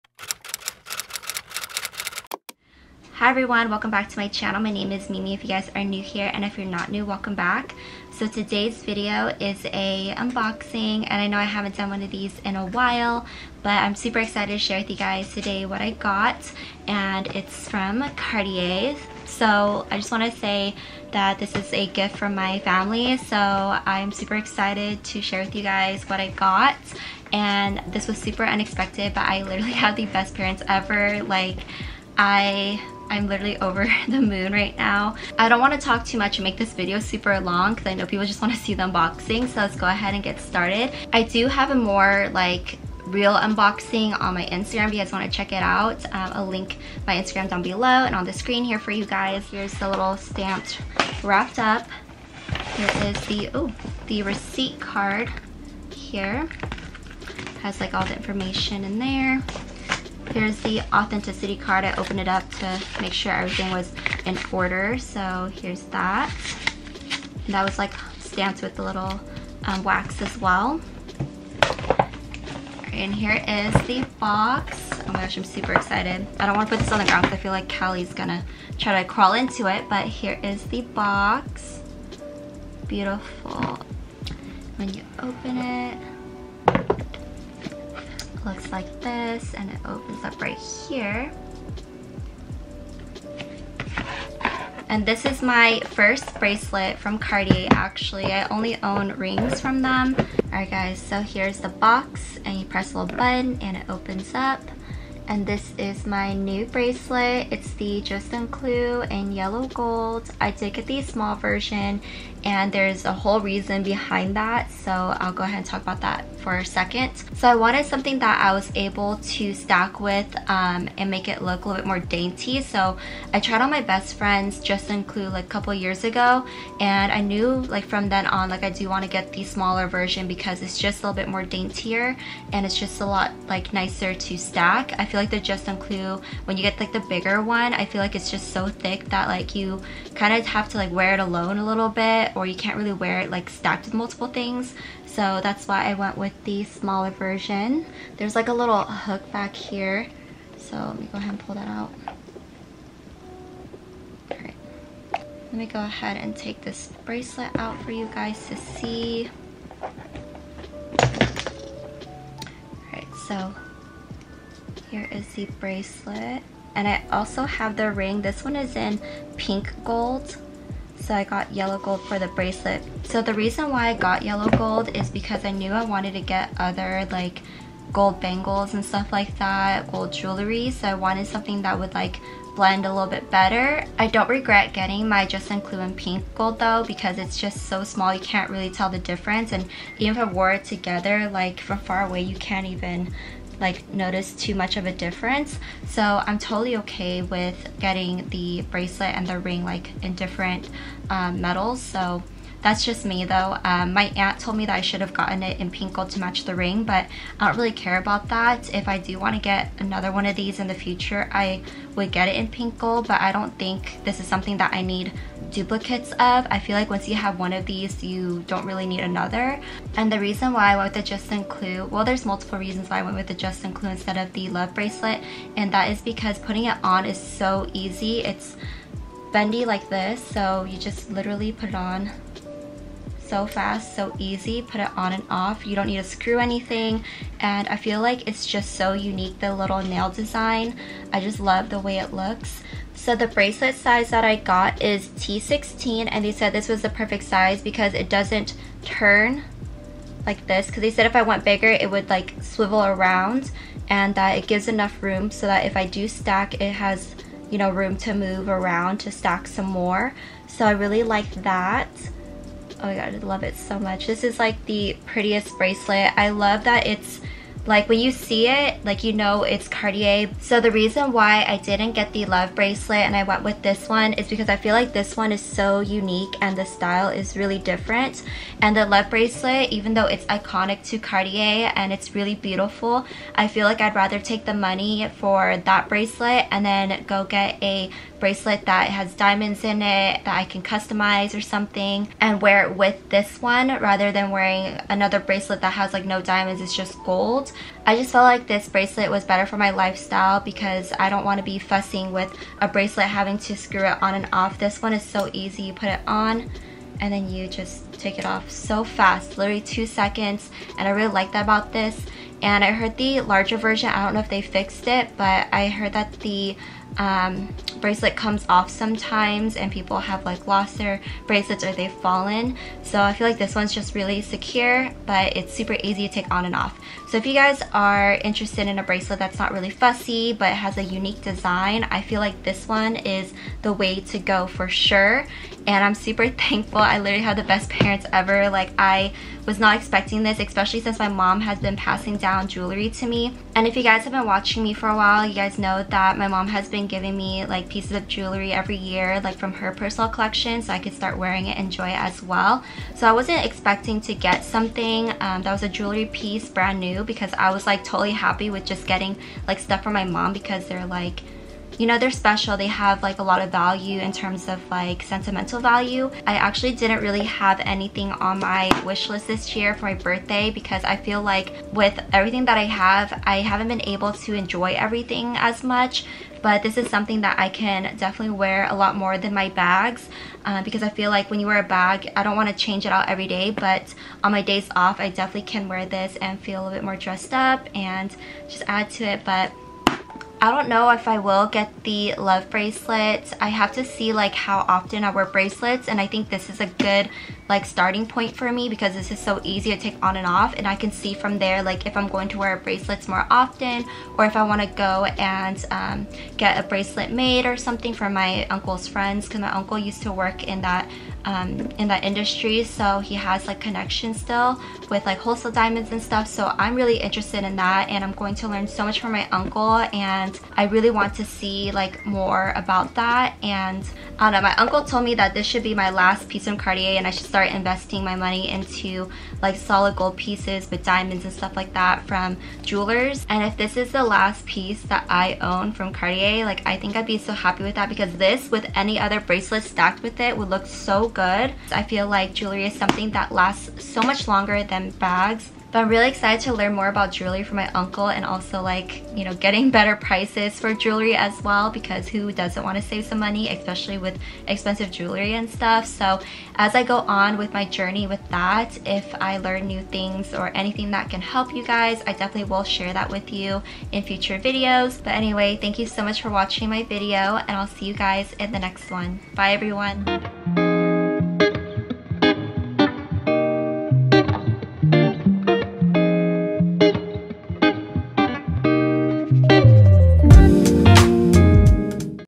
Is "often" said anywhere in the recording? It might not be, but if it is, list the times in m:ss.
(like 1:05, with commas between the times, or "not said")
6:34, 6:43.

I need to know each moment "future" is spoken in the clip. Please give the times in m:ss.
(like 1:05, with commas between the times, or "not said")
3:30, 7:44.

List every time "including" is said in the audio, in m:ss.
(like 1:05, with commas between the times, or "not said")
3:05.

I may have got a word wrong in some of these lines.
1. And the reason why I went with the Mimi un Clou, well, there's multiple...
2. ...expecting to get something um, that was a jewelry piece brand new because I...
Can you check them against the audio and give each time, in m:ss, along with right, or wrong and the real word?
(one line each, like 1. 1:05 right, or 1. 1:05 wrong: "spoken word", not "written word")
1. 3:39 wrong: "Juste", not "Mimi"
2. 5:53 right.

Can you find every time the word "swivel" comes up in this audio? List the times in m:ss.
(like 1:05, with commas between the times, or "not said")
4:12.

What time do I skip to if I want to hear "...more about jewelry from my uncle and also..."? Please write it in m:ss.
7:26.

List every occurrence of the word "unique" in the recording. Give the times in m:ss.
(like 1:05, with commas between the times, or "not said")
3:58, 4:35, 5:30.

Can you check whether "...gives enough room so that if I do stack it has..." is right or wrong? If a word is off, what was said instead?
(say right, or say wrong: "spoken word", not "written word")
right.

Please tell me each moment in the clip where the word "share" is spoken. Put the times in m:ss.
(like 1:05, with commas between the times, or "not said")
0:14, 0:25, 7:42.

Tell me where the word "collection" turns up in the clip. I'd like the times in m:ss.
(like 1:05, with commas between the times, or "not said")
5:50.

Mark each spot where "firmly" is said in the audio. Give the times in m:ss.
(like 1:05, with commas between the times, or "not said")
not said.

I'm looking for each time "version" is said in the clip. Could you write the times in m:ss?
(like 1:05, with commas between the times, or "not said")
1:51, 2:09, 2:27, 5:13.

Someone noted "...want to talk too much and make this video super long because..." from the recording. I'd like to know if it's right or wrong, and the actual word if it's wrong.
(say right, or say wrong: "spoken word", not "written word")
right.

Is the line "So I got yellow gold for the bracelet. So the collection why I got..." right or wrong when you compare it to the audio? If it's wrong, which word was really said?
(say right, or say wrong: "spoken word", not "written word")
wrong: "reason", not "collection".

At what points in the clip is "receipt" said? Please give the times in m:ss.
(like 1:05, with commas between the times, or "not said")
0:54.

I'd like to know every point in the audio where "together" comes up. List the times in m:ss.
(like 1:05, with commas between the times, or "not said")
3:10.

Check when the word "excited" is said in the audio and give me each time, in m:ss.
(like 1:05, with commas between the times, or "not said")
0:14, 0:24, 1:15, 7:26.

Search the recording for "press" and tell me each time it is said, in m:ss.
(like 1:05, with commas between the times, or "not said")
1:42.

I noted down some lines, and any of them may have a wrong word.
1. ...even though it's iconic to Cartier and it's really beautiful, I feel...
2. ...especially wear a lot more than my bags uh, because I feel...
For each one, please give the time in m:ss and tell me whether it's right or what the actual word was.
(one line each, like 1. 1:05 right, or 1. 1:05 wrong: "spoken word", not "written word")
1. 4:39 right
2. 6:17 wrong: "definitely", not "especially".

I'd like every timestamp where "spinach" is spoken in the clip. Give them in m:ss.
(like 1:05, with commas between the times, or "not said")
not said.